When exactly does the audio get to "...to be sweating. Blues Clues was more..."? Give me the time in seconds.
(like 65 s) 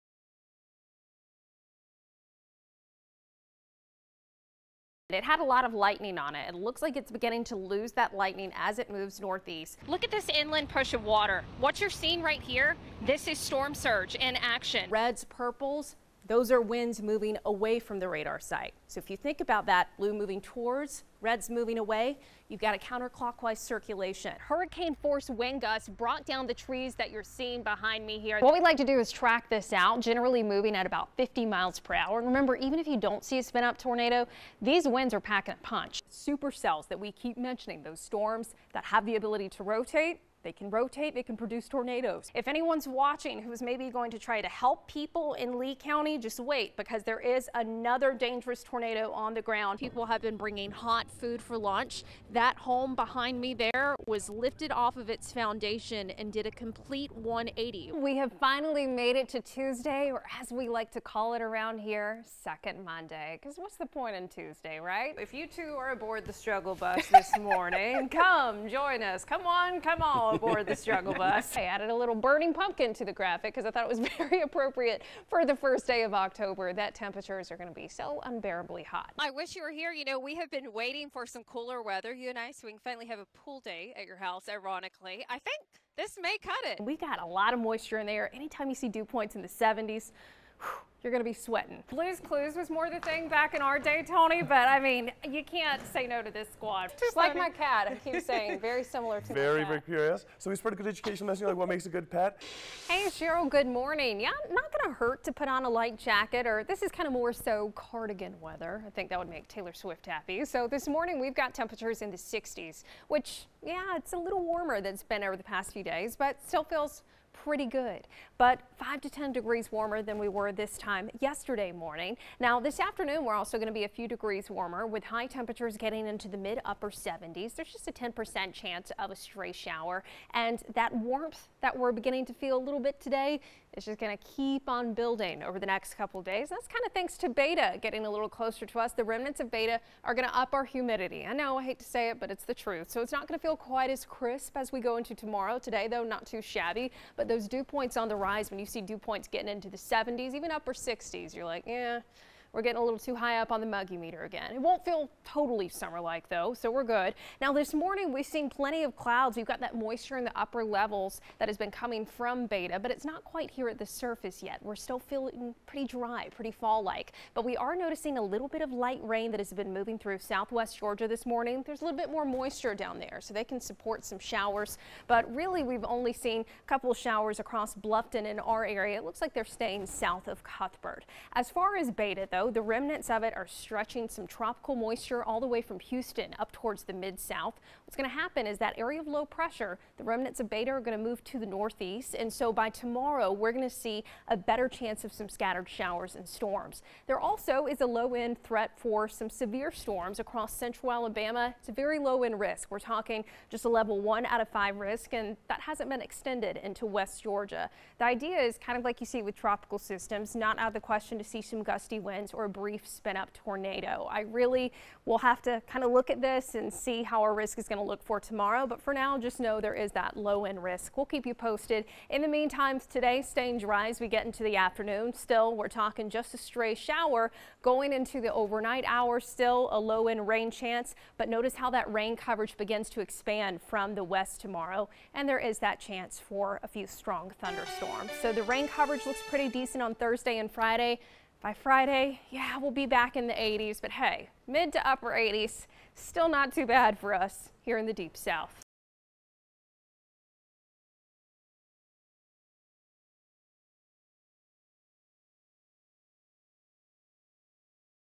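91 s.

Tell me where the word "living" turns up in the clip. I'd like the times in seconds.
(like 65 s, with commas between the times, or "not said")
not said.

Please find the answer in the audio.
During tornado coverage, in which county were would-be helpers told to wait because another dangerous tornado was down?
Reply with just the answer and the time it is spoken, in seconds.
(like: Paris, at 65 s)
Lee County, at 45 s.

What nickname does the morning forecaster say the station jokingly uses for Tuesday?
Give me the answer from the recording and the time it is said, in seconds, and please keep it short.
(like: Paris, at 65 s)
Second Monday, at 62 s.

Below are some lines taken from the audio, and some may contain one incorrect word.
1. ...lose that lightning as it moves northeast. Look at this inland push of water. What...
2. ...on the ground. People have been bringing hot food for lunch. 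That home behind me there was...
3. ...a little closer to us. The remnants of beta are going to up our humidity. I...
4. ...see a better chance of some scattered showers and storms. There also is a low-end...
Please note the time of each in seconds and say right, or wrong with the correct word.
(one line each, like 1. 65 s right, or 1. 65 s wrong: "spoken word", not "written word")
1. 7 s right
2. 49 s right
3. 138 s right
4. 193 s right.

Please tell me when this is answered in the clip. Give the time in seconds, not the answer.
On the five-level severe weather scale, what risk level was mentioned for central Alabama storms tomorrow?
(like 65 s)
203 s.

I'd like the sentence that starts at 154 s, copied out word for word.
It won't feel totally summer-like though, so we're good.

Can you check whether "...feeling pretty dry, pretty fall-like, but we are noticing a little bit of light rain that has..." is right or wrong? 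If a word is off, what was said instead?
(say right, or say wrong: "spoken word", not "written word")
right.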